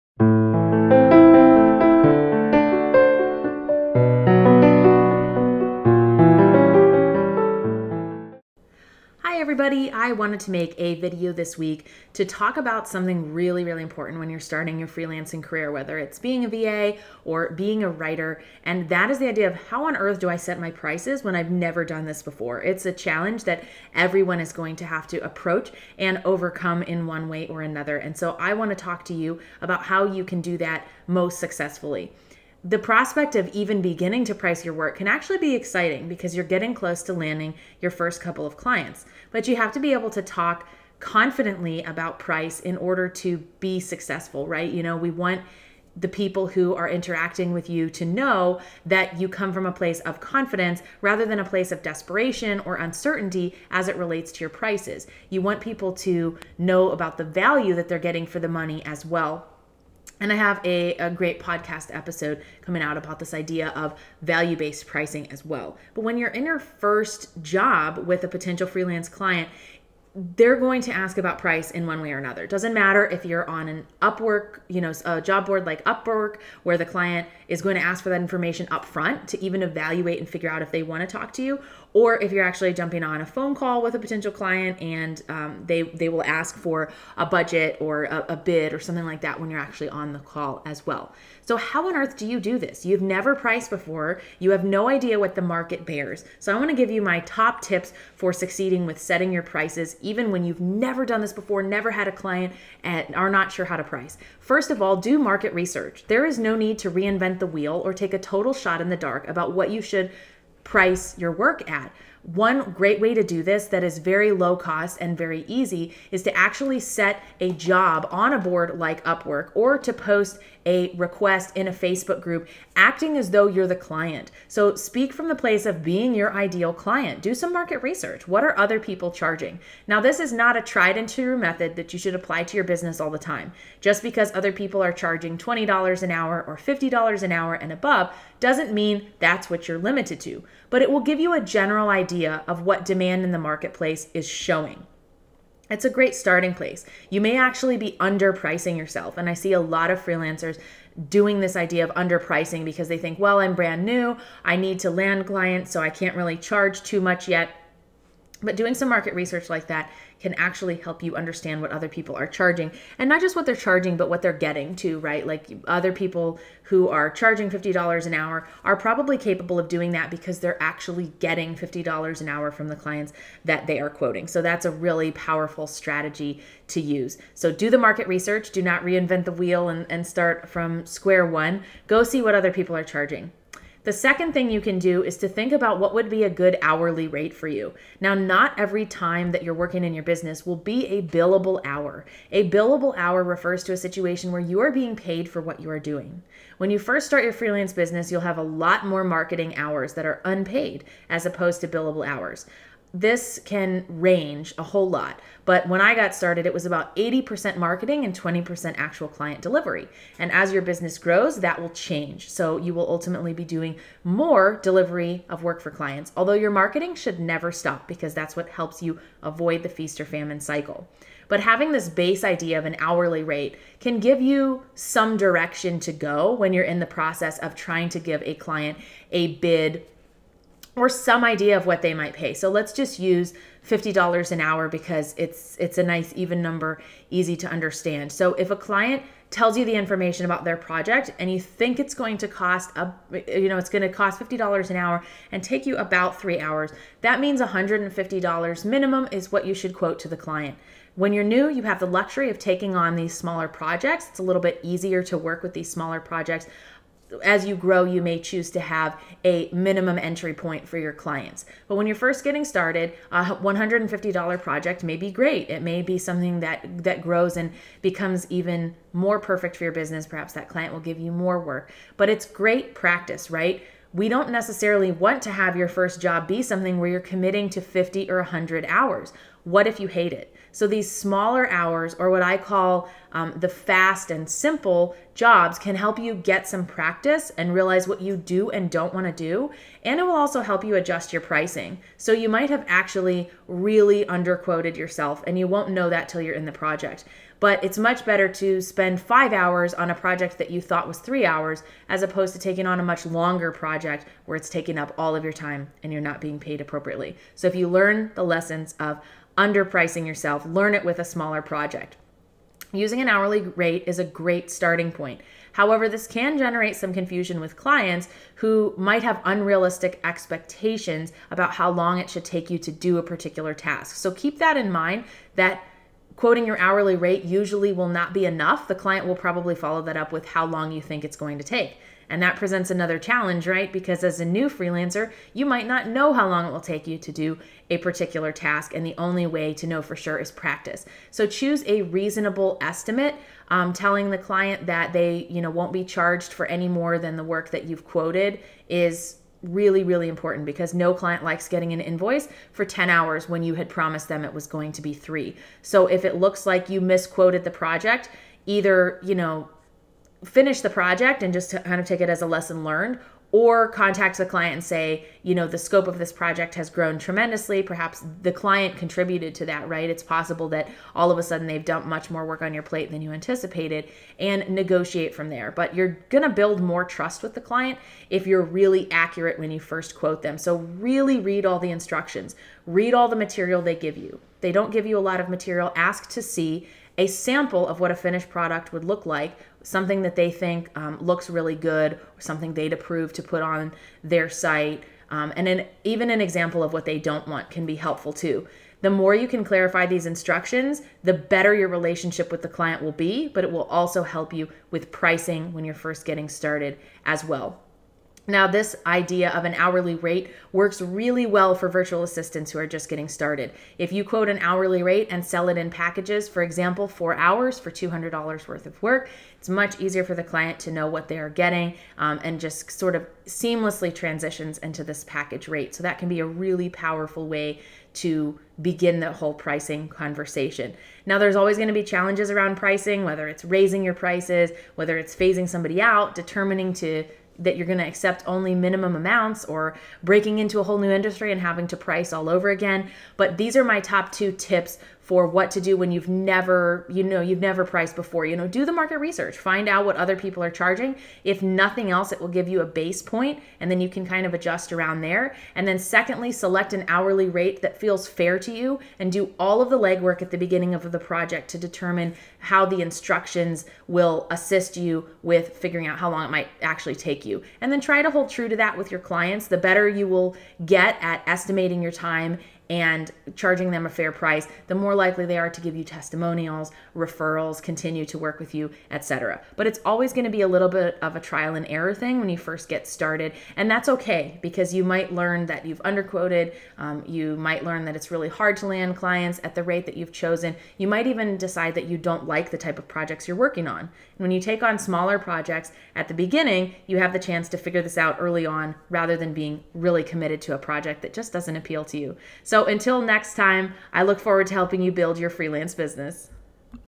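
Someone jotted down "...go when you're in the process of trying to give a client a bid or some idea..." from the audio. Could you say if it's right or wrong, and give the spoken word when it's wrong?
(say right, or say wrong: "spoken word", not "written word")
right.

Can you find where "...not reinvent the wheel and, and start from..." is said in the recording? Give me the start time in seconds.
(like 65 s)
178 s.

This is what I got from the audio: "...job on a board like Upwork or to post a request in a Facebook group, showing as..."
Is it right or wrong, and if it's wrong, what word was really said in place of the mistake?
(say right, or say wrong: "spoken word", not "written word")
wrong: "acting", not "showing".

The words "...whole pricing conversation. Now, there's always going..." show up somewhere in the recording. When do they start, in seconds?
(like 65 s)
429 s.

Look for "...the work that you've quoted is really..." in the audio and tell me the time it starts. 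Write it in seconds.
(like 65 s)
347 s.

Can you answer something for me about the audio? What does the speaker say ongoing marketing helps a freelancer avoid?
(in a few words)
feast or famine cycle.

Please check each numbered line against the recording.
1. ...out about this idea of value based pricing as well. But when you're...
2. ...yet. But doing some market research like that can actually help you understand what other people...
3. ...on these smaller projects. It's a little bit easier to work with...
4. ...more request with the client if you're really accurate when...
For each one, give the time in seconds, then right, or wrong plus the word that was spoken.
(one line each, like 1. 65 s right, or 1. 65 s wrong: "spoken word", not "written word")
1. 62 s right
2. 157 s right
3. 252 s right
4. 376 s wrong: "trust", not "request".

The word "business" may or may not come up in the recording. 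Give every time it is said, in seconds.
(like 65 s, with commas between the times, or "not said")
132 s, 190 s, 197 s, 210 s, 269 s, 505 s.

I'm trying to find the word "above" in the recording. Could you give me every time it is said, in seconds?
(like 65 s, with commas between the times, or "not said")
137 s.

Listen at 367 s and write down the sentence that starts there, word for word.
Perhaps the client contributed to that, right?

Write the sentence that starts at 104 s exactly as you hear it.
First of all, do market research.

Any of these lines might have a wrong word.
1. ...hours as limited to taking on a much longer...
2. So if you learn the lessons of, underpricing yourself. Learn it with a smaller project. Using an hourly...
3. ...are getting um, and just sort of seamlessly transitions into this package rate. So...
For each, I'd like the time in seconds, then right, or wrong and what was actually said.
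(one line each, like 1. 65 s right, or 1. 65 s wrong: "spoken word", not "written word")
1. 301 s wrong: "opposed", not "limited"
2. 307 s right
3. 421 s right.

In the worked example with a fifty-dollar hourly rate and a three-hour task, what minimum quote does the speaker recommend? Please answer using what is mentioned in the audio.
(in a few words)
$150.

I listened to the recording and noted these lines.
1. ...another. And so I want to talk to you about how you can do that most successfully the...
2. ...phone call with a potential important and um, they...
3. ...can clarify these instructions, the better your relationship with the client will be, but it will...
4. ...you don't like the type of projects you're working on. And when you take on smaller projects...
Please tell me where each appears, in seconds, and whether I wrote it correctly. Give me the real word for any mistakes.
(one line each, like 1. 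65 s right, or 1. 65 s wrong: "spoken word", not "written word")
1. 27 s right
2. 83 s wrong: "client", not "important"
3. 399 s right
4. 491 s right.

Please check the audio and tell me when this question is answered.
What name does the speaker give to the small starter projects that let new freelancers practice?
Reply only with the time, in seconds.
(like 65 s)
283 s.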